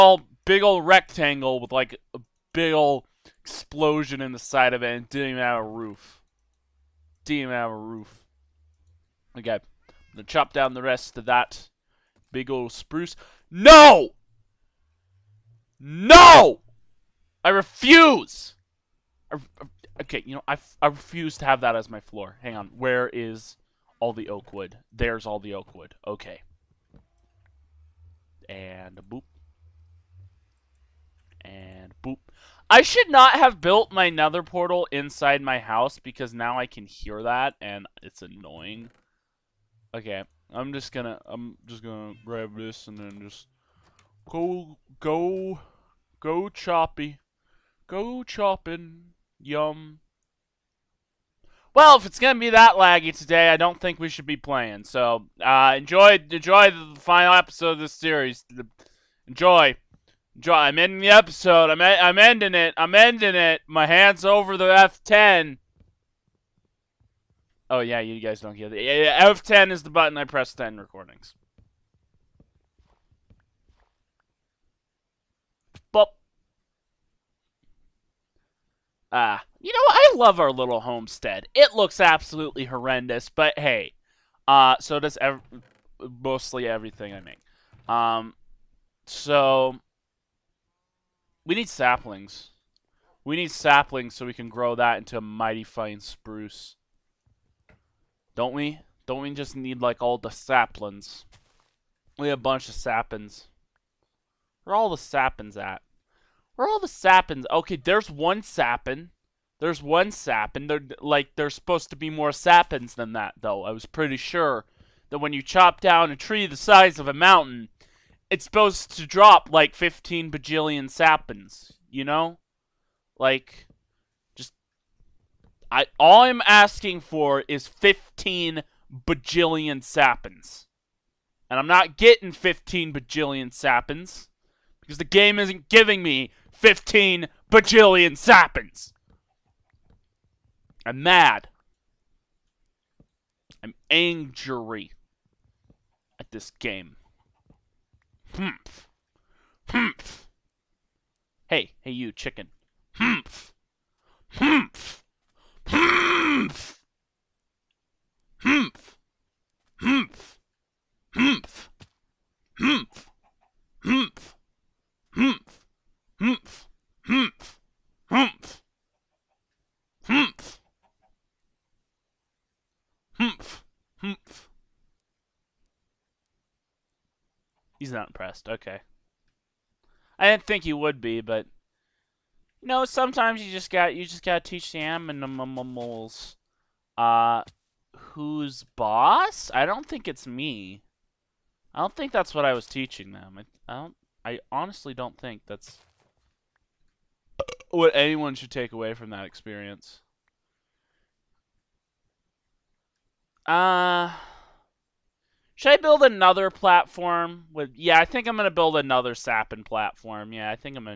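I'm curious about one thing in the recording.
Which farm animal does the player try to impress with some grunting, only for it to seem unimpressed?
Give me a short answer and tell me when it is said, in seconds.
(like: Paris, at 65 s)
Chicken, at 152 s.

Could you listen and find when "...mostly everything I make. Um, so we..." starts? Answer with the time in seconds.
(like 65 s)
85 s.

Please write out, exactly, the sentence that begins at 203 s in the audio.
Uh should I build another platform?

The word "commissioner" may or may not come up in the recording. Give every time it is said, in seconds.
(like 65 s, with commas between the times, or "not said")
not said.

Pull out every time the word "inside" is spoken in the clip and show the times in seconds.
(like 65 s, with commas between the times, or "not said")
34 s.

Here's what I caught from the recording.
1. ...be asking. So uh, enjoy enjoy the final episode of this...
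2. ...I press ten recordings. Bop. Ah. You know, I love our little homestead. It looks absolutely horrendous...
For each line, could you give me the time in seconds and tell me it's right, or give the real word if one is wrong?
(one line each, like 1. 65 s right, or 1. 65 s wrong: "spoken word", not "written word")
1. 54 s wrong: "playing", not "asking"
2. 70 s right.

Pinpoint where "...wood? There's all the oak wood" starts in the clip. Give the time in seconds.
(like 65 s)
24 s.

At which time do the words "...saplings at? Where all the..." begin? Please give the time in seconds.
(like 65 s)
104 s.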